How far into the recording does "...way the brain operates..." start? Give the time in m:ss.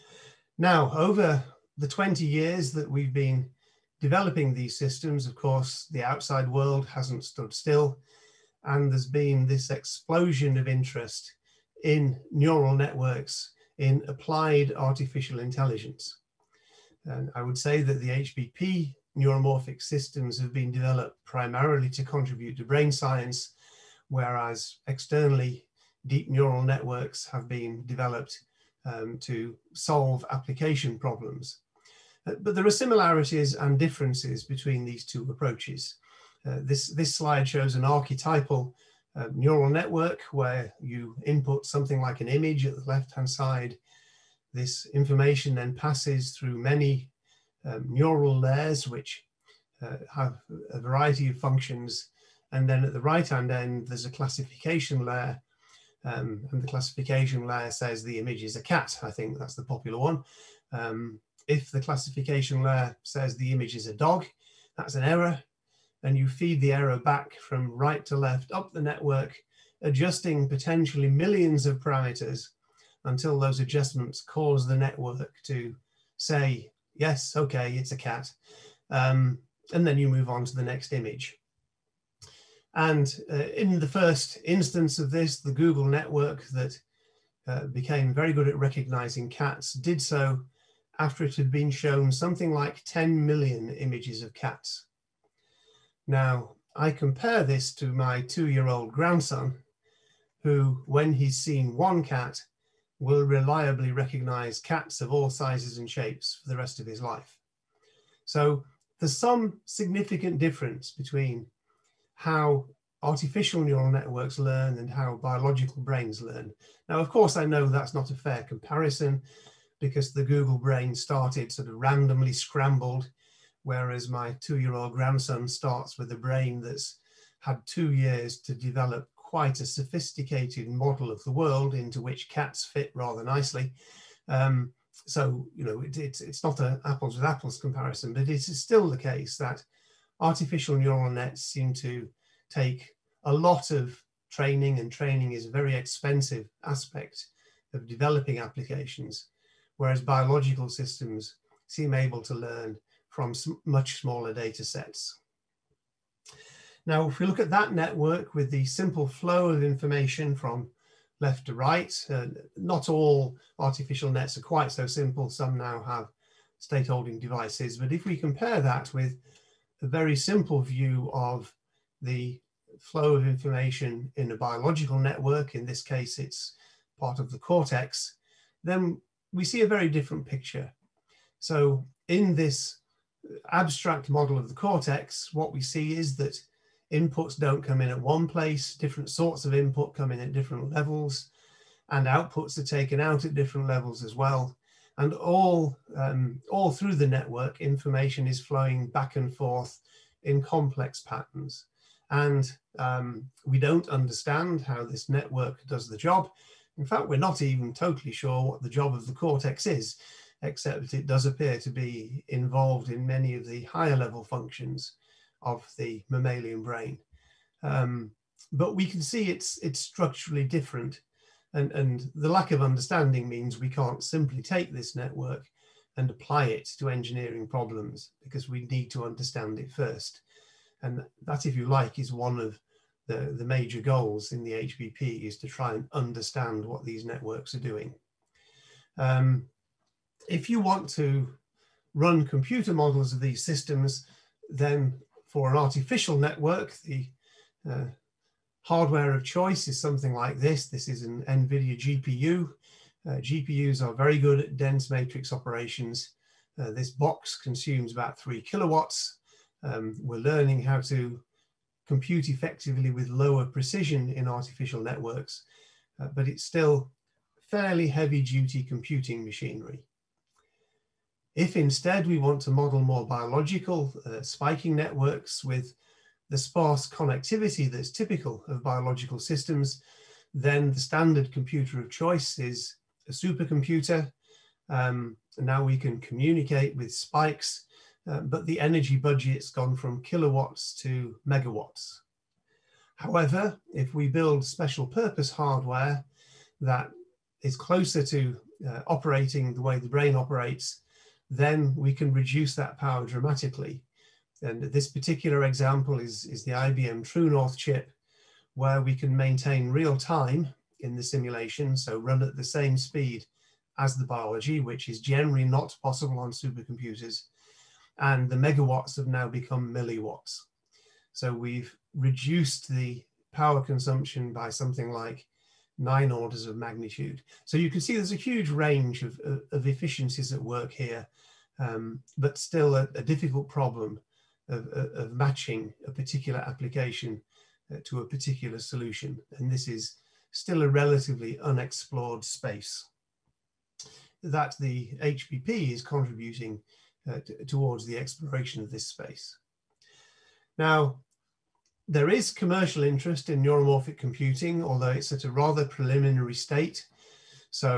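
4:59.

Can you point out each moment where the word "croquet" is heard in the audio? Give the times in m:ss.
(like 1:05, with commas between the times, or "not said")
not said.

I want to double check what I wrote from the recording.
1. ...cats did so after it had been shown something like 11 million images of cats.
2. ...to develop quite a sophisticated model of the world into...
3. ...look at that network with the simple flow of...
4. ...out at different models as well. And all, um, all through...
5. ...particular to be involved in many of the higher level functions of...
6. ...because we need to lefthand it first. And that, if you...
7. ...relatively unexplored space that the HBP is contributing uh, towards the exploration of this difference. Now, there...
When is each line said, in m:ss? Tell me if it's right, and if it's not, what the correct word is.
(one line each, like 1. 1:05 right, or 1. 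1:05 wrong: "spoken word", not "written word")
1. 1:29 wrong: "10", not "11"
2. 2:08 right
3. 2:37 right
4. 3:12 wrong: "levels", not "models"
5. 3:31 wrong: "appear", not "particular"
6. 3:48 wrong: "understand", not "lefthand"
7. 5:40 wrong: "space", not "difference".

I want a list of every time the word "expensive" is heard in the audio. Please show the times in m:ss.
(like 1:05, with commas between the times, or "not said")
2:25.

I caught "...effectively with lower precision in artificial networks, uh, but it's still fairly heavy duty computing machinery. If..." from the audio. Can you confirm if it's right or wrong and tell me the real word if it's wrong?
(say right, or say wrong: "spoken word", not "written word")
right.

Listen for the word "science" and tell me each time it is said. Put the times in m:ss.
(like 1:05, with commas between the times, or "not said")
0:22.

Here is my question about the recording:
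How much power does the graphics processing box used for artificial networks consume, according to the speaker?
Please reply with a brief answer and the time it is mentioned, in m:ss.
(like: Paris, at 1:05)
3 kilowatts, at 4:18.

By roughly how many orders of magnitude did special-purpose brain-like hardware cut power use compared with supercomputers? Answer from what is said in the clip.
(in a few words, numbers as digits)
9.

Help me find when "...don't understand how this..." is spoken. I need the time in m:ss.
3:23.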